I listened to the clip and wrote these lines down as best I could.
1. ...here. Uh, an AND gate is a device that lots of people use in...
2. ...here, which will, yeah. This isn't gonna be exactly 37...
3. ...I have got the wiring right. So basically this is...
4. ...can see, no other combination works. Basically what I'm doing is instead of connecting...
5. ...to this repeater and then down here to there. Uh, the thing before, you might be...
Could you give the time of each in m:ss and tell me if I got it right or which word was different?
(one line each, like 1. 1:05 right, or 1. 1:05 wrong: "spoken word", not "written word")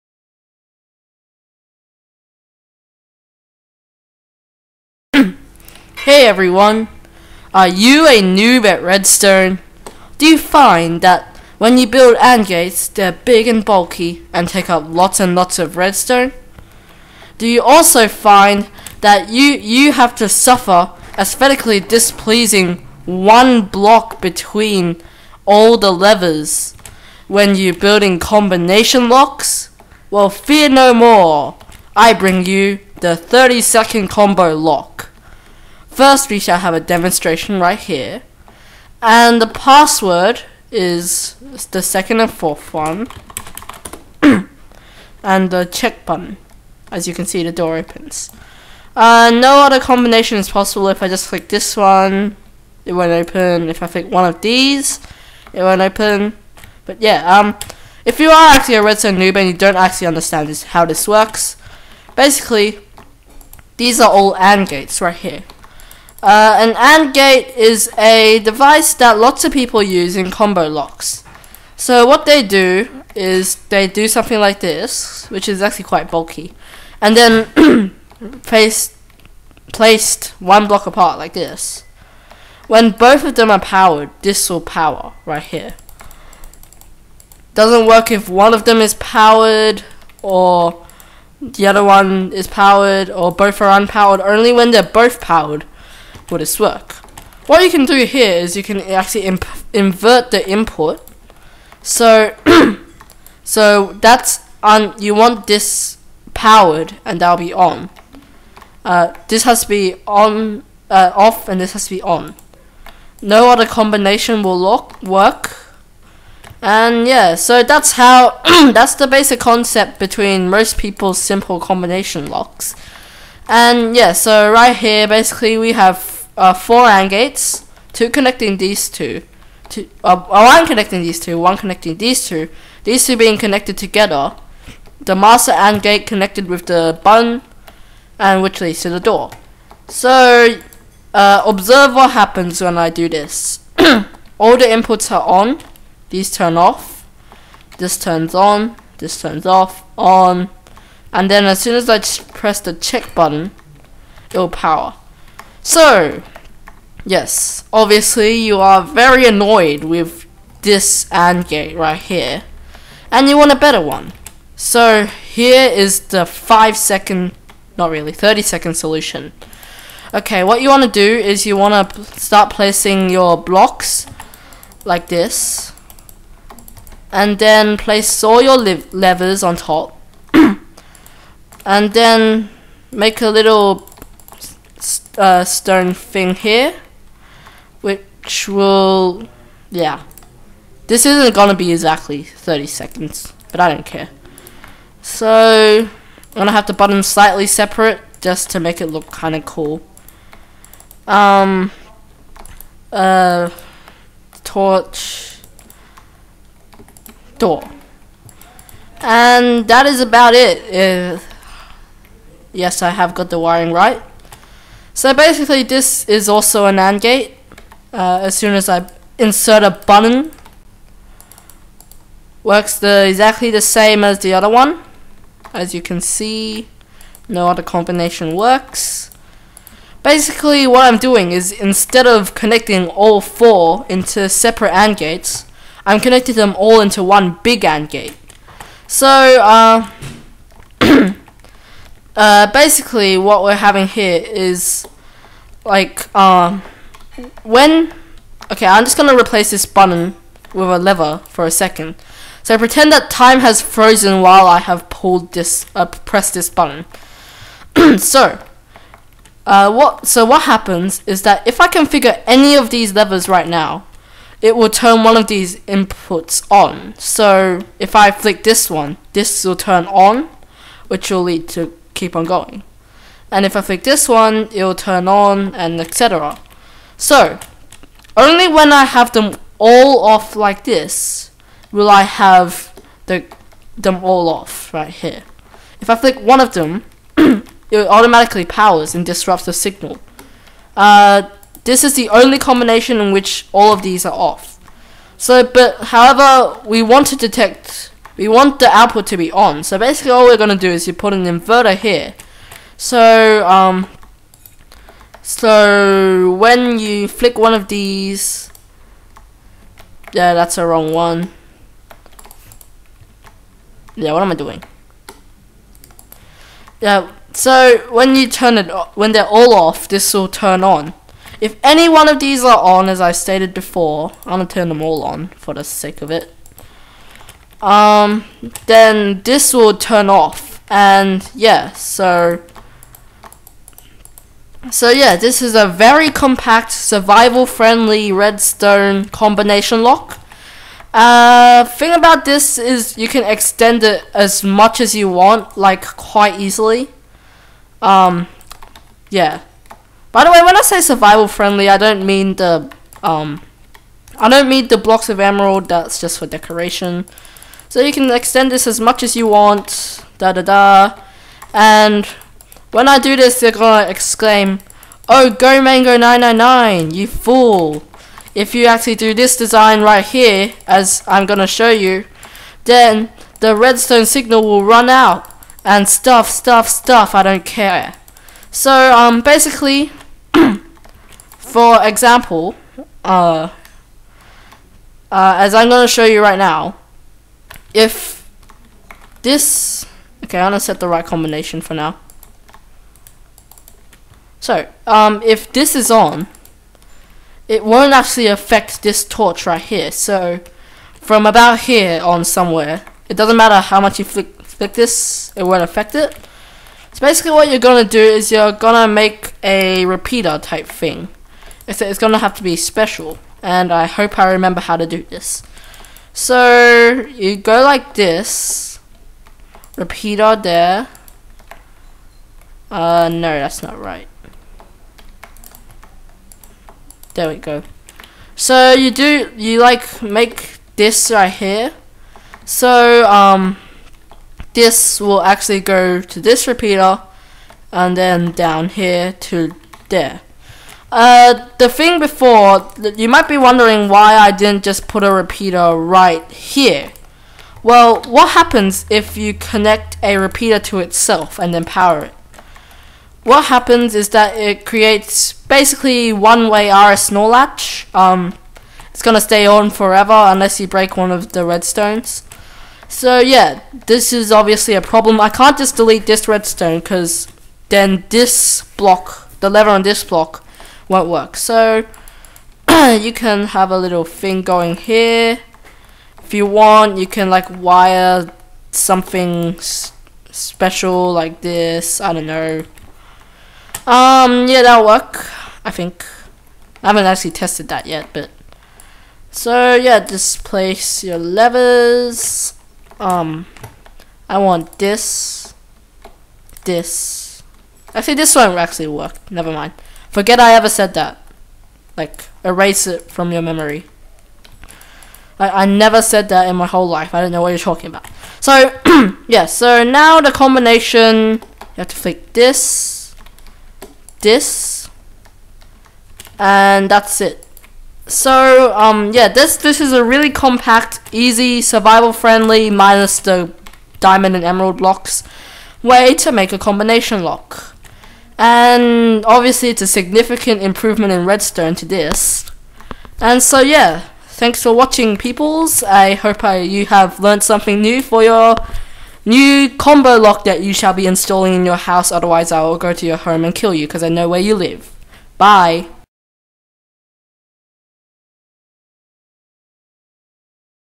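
1. 1:05 right
2. 3:06 wrong: "30", not "37"
3. 3:32 right
4. 3:45 right
5. 7:16 right.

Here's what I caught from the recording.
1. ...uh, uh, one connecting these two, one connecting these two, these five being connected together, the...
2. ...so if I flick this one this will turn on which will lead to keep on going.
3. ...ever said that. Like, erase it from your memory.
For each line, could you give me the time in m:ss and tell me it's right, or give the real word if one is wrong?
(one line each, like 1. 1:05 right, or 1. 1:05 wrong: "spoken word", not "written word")
1. 2:10 wrong: "two", not "five"
2. 4:26 right
3. 8:20 right.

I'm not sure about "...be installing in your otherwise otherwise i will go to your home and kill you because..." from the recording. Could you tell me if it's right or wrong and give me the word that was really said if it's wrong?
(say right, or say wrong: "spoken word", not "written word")
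wrong: "house", not "otherwise".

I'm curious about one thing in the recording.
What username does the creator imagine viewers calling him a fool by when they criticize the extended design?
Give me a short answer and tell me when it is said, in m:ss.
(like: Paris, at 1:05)
Mango 999, at 6:05.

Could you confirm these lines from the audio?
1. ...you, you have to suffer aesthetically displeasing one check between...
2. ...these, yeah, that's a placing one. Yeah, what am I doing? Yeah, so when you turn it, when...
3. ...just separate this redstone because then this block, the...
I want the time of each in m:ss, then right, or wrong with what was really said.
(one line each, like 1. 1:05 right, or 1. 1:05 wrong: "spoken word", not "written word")
1. 0:19 wrong: "block", not "check"
2. 5:07 wrong: "wrong", not "placing"
3. 7:45 wrong: "delete", not "separate".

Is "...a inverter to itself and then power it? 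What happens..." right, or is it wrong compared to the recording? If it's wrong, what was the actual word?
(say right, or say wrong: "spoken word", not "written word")
wrong: "repeater", not "inverter".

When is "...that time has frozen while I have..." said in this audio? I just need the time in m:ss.
4:12.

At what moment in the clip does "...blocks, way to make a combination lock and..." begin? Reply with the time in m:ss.
8:44.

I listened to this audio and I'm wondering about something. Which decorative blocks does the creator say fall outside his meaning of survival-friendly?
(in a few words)
blocks of emerald.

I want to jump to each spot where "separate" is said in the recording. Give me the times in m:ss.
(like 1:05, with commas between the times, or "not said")
3:17, 3:54.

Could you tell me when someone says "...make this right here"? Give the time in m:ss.
7:10.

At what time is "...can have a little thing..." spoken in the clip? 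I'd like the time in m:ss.
7:53.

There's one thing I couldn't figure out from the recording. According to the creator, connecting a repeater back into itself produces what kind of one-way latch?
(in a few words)
RS NOR latch.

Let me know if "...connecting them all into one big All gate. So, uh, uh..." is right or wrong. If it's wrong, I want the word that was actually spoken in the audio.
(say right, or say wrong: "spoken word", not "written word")
wrong: "AND", not "All".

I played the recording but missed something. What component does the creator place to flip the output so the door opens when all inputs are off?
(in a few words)
inverter.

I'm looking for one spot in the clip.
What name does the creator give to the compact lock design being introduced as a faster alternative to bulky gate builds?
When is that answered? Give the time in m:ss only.
0:33.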